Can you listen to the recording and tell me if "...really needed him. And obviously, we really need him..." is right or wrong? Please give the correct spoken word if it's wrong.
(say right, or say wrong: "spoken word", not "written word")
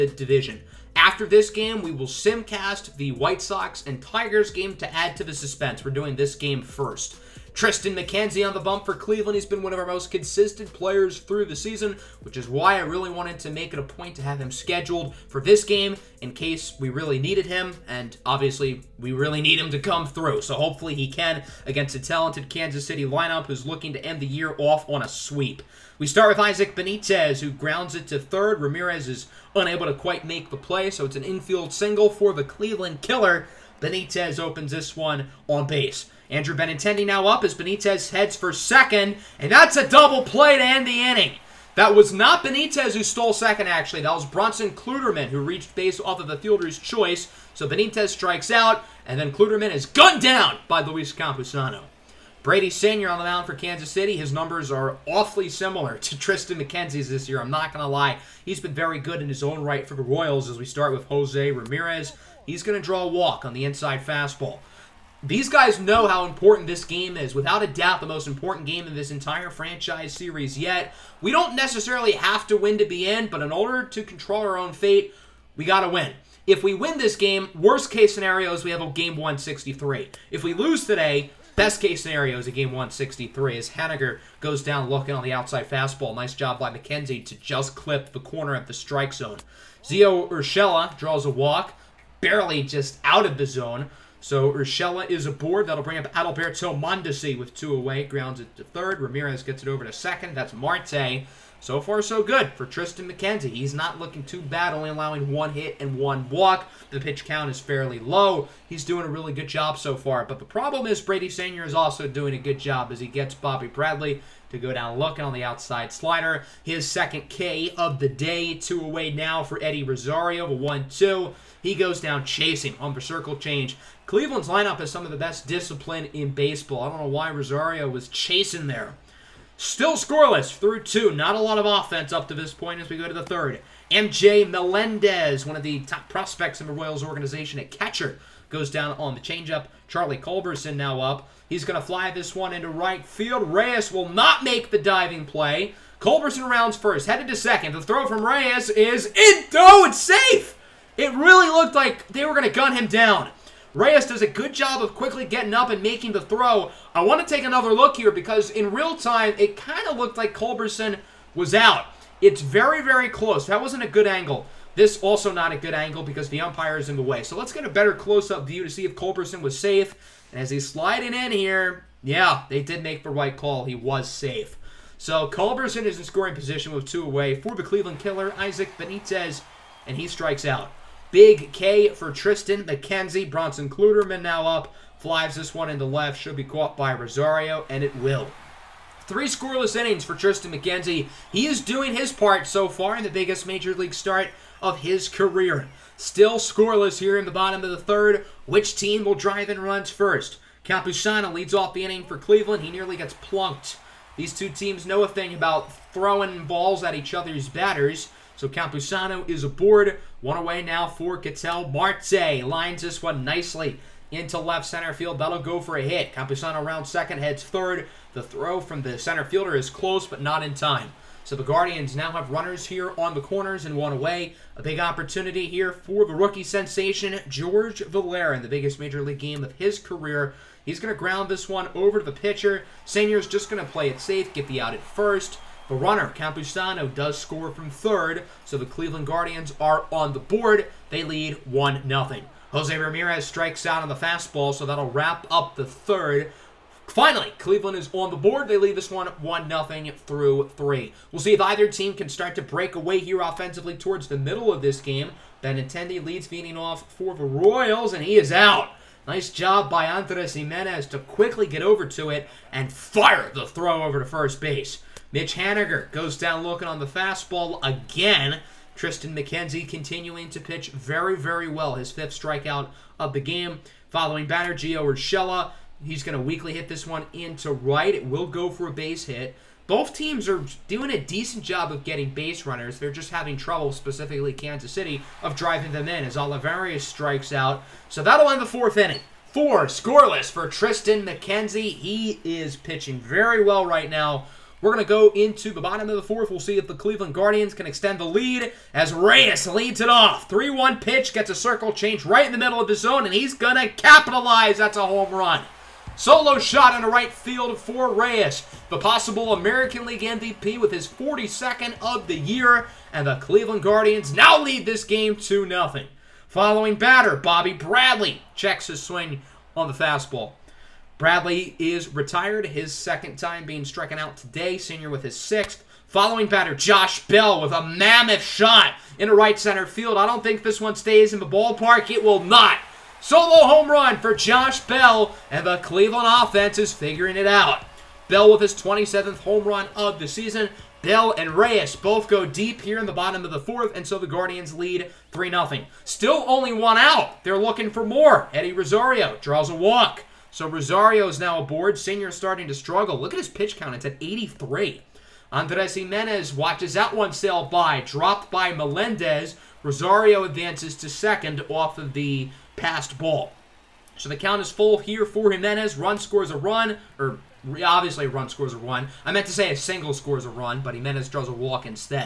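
right.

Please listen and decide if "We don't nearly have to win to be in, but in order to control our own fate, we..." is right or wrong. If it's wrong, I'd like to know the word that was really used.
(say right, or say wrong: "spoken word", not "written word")
wrong: "necessarily", not "nearly".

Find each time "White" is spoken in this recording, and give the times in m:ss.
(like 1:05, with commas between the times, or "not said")
0:03.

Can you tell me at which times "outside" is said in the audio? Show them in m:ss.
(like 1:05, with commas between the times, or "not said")
1:25, 1:55.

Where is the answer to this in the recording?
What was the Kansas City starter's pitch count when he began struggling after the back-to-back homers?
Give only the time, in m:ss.
5:54.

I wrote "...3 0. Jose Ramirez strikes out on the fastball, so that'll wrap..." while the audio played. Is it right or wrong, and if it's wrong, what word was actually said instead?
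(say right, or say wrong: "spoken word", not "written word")
wrong: "1", not "3".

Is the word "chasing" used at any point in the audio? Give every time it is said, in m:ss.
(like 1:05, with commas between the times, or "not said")
2:02, 2:08.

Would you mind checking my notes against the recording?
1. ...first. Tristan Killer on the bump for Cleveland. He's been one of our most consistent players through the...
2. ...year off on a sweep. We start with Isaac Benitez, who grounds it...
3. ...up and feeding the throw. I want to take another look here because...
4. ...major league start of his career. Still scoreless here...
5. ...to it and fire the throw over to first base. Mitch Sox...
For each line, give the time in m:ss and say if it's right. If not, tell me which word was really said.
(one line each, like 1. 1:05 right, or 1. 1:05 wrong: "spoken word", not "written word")
1. 0:06 wrong: "McKenzie", not "Killer"
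2. 0:24 right
3. 2:35 wrong: "making", not "feeding"
4. 3:13 right
5. 4:21 wrong: "Haniger", not "Sox".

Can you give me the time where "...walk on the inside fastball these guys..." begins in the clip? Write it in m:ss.
1:03.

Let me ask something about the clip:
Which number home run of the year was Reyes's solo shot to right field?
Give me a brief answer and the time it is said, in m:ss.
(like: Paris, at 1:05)
42, at 5:10.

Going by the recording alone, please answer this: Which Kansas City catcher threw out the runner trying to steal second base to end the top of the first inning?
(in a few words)
Luis Campusano.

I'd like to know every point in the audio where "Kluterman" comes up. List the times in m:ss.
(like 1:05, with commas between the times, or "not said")
0:44, 0:49, 3:03.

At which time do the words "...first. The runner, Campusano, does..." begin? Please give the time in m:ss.
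3:54.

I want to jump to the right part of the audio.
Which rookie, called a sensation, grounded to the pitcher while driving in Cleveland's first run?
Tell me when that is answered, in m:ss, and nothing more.
3:47.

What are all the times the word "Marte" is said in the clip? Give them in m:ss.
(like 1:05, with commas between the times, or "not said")
1:40, 3:31.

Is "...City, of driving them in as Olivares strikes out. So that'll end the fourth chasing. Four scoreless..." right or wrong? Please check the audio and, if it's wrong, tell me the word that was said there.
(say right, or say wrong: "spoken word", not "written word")
wrong: "inning", not "chasing".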